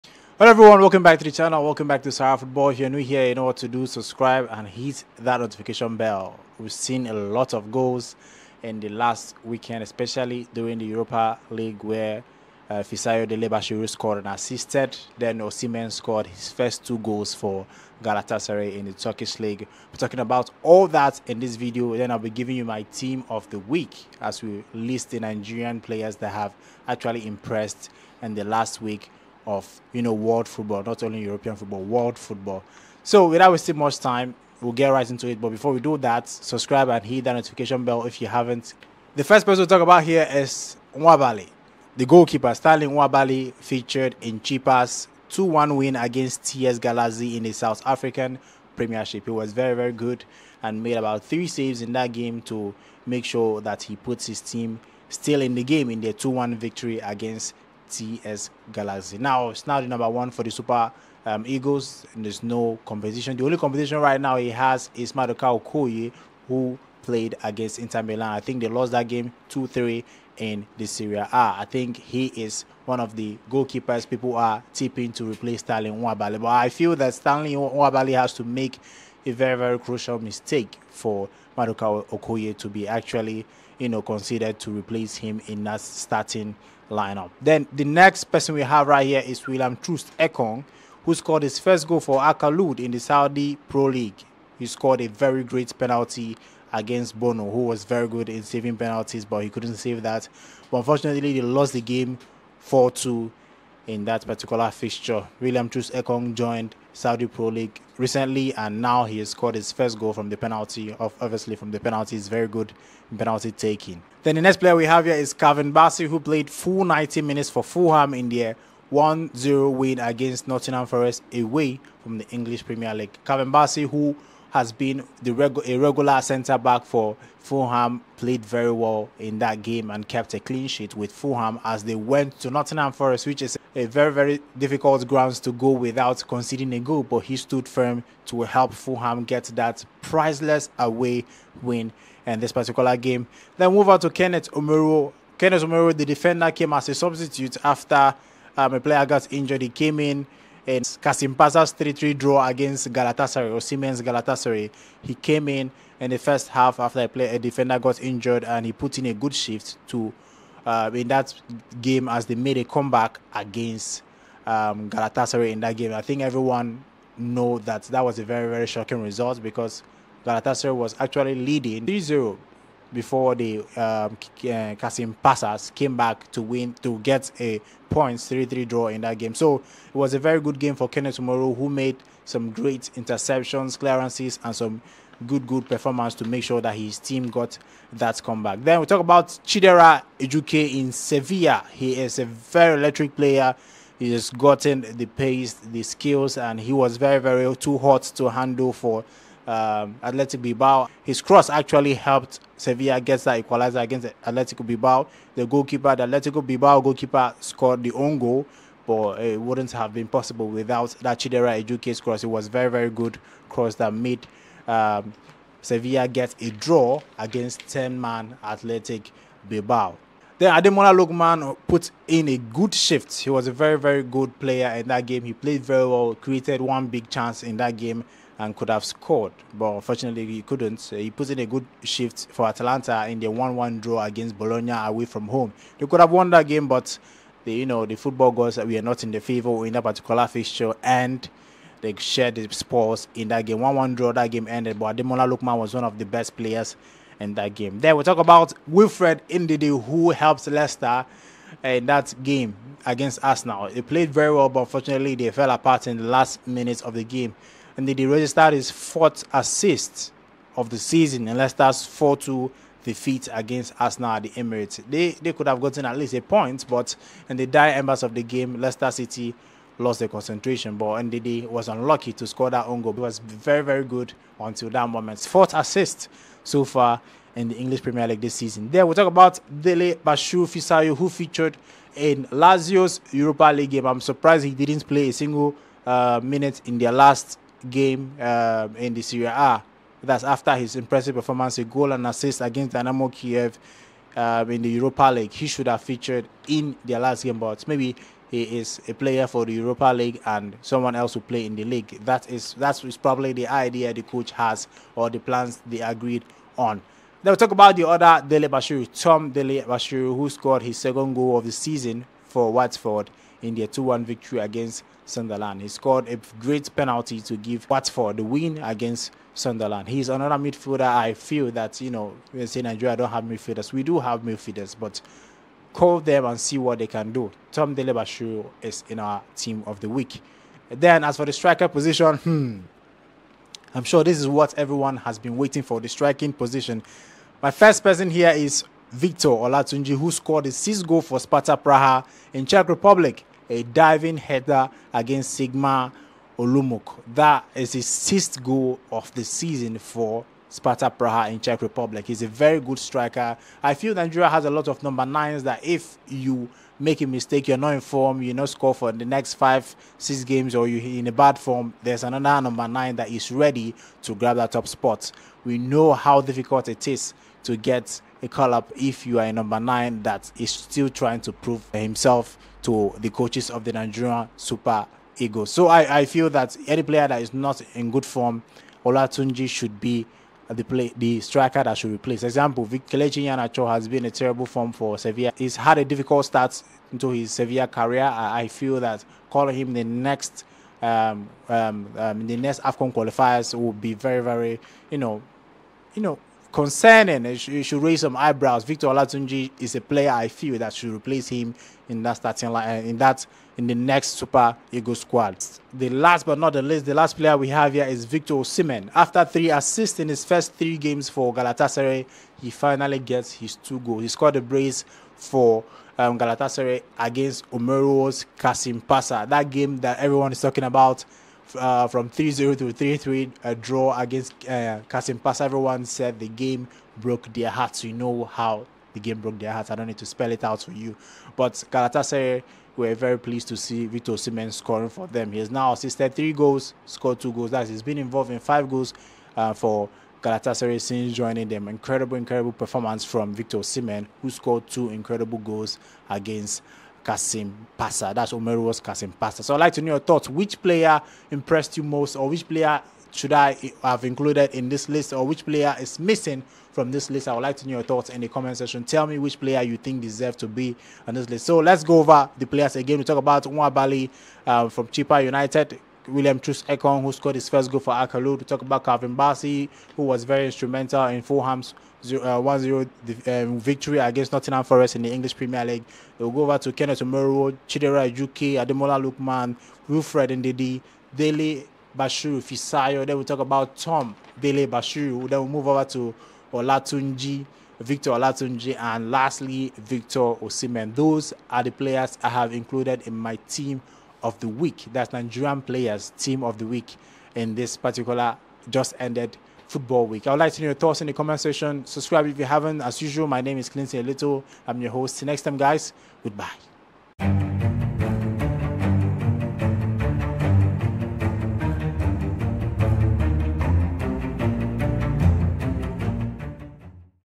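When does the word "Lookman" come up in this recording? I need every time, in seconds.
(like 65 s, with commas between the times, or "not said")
220 s, 245 s, 478 s.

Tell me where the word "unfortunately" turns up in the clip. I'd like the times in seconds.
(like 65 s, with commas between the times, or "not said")
100 s, 229 s, 254 s.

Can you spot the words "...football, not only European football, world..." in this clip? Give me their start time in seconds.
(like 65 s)
30 s.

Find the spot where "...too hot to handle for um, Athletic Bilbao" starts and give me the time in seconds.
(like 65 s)
197 s.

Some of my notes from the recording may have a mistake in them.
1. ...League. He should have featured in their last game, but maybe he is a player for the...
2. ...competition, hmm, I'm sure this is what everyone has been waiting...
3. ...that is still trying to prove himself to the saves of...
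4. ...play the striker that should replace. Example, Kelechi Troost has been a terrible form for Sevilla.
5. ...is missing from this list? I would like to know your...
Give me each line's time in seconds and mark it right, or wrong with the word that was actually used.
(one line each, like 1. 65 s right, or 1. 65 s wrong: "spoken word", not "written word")
1. 295 s right
2. 331 s wrong: "position", not "competition"
3. 370 s wrong: "coaches", not "saves"
4. 380 s wrong: "Iheanacho", not "Troost"
5. 455 s right.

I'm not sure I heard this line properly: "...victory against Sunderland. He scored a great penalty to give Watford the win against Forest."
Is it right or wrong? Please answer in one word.
wrong.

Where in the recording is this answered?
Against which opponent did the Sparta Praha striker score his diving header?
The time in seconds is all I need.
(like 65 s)
345 s.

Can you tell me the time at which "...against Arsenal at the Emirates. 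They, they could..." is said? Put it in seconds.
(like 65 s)
263 s.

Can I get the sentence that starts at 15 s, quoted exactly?
Then Osimhen scored his first two goals for Galatasaray in the Turkish League.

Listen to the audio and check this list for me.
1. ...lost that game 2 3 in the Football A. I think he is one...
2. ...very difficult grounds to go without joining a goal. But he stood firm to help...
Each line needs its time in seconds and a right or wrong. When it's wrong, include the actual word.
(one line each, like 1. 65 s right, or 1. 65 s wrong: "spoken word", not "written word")
1. 68 s wrong: "Serie", not "Football"
2. 134 s wrong: "conceding", not "joining".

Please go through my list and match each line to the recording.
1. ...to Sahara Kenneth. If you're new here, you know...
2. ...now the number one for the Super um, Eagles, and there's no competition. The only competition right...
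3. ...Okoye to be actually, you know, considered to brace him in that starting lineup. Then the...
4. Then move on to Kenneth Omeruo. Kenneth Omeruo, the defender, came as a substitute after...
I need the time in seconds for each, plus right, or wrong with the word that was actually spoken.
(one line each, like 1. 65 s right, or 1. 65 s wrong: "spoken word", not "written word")
1. 2 s wrong: "Football", not "Kenneth"
2. 59 s right
3. 82 s wrong: "replace", not "brace"
4. 143 s right.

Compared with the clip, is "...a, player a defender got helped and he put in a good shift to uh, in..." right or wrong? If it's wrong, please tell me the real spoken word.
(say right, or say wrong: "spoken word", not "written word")
wrong: "injured", not "helped".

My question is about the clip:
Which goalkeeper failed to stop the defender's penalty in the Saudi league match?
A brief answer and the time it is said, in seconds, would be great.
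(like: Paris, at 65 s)
Bounou, at 97 s.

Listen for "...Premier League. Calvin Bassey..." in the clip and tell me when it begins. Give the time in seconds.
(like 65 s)
122 s.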